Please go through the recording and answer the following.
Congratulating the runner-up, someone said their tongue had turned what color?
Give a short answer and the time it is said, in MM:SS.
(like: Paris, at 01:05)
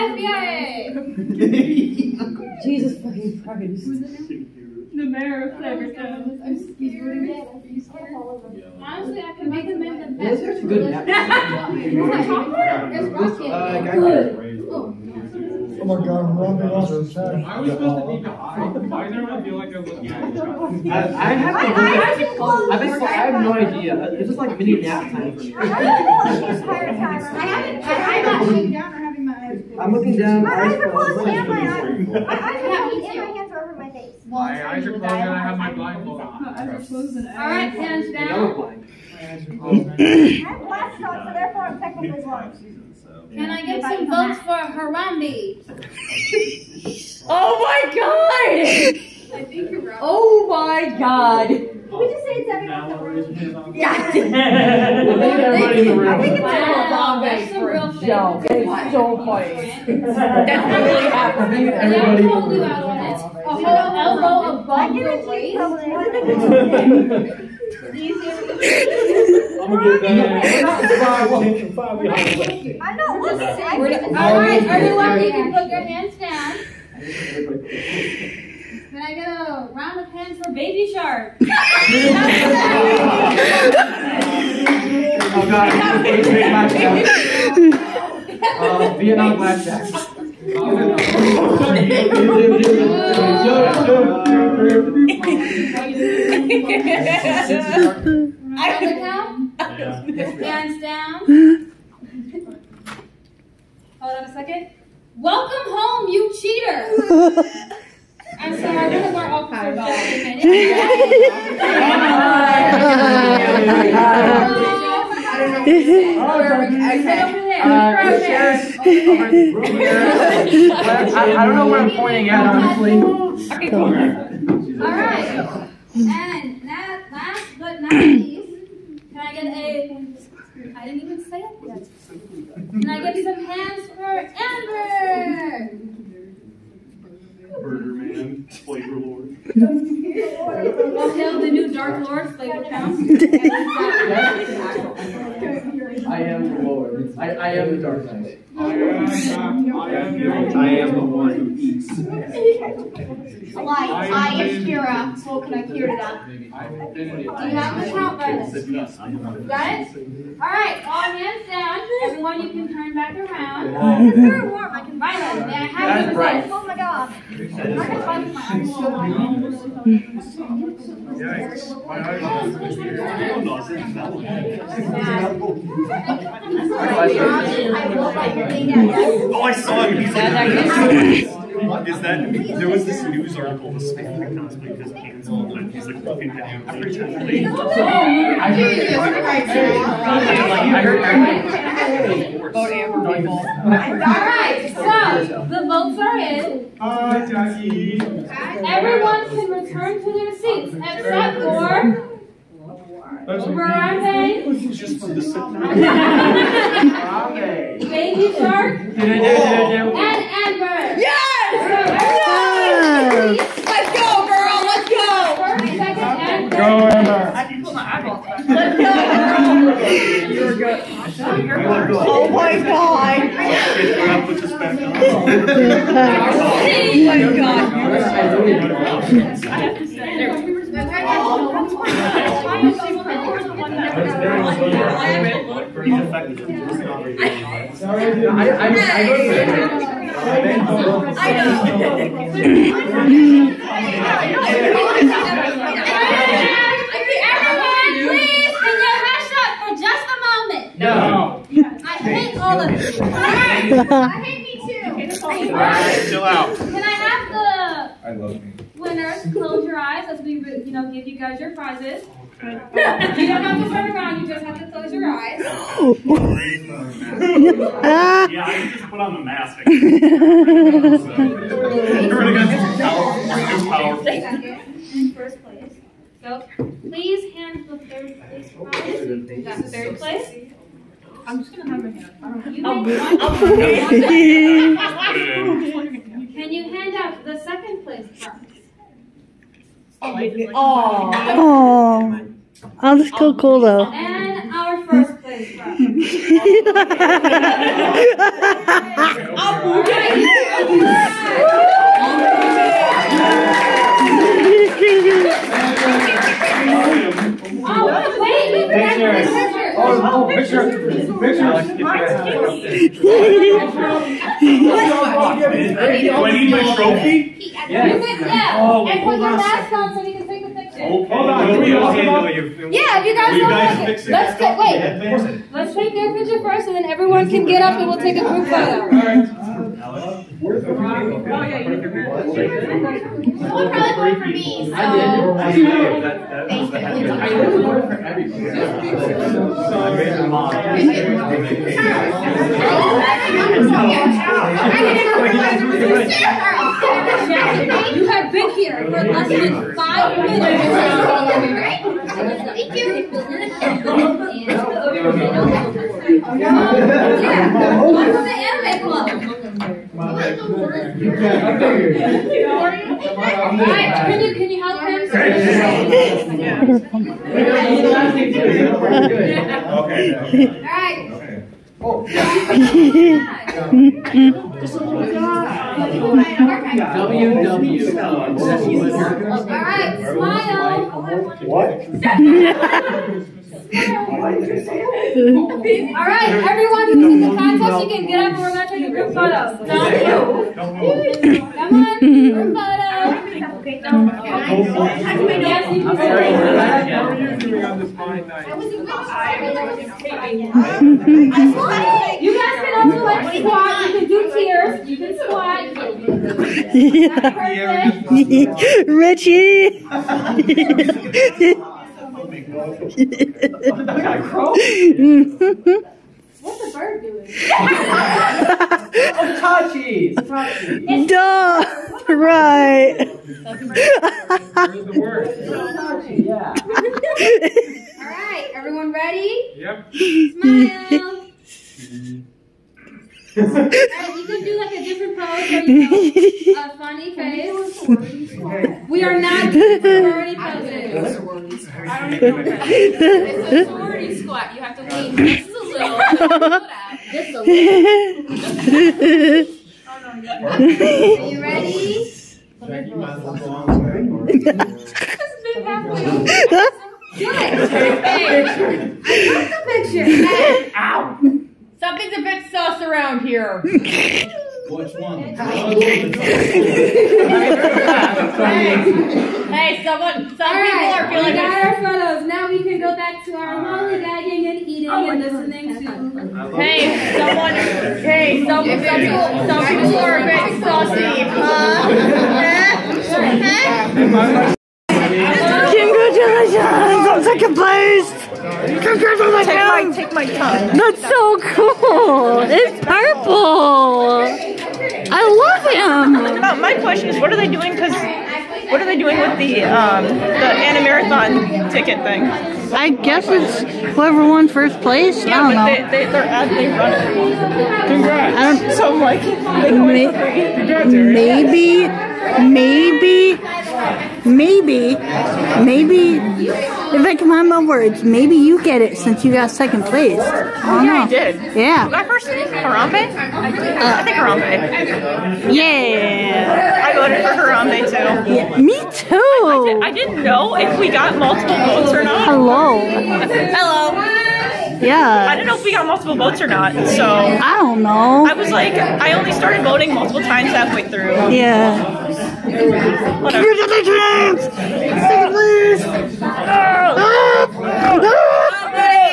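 Purple, at 08:12.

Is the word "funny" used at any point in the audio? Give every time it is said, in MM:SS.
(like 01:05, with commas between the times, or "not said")
00:59, 07:16.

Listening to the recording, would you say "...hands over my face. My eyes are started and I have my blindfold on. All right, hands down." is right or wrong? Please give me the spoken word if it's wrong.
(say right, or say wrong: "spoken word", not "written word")
wrong: "closed", not "started".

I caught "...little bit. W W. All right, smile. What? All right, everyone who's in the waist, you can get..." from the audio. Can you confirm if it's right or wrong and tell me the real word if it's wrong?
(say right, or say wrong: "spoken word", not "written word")
wrong: "contest", not "waist".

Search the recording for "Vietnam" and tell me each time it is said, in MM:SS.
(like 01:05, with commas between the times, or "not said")
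01:28, 01:37.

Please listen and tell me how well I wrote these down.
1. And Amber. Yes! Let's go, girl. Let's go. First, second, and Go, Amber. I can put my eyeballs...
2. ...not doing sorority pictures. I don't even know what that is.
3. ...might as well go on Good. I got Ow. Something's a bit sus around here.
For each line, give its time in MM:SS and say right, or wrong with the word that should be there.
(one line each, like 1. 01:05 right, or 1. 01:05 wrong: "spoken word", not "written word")
1. 03:28 right
2. 07:19 wrong: "poses", not "pictures"
3. 07:32 right.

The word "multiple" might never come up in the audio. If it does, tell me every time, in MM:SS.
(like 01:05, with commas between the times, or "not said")
08:51, 08:55, 08:59.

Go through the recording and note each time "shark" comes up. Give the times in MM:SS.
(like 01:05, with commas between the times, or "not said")
01:20, 03:28.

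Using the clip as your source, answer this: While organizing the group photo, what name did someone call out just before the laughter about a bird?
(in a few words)
Richie.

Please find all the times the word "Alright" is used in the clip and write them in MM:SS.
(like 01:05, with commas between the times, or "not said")
02:39, 03:13, 06:10, 07:08, 07:13.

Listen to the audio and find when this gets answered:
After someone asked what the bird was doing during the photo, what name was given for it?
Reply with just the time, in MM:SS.
06:57.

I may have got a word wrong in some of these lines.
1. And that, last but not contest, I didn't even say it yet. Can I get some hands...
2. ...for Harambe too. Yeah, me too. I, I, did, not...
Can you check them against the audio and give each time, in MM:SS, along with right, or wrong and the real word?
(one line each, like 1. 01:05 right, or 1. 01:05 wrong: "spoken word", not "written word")
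1. 02:05 wrong: "least", not "contest"
2. 08:47 right.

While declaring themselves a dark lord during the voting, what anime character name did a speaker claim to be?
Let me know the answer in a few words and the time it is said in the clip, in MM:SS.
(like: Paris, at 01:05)
Kira, at 02:33.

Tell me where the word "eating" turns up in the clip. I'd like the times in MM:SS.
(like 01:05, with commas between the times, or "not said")
07:54.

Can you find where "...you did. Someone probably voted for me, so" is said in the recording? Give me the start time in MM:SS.
05:31.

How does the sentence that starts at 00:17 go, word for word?
I was supposed to be behind there, I feel like I was looking at I have I, have no idea.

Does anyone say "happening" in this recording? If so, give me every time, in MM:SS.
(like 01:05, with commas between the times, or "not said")
01:01.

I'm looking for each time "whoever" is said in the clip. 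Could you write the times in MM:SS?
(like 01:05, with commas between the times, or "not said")
08:23.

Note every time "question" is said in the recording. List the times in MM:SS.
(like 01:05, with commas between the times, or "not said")
08:16.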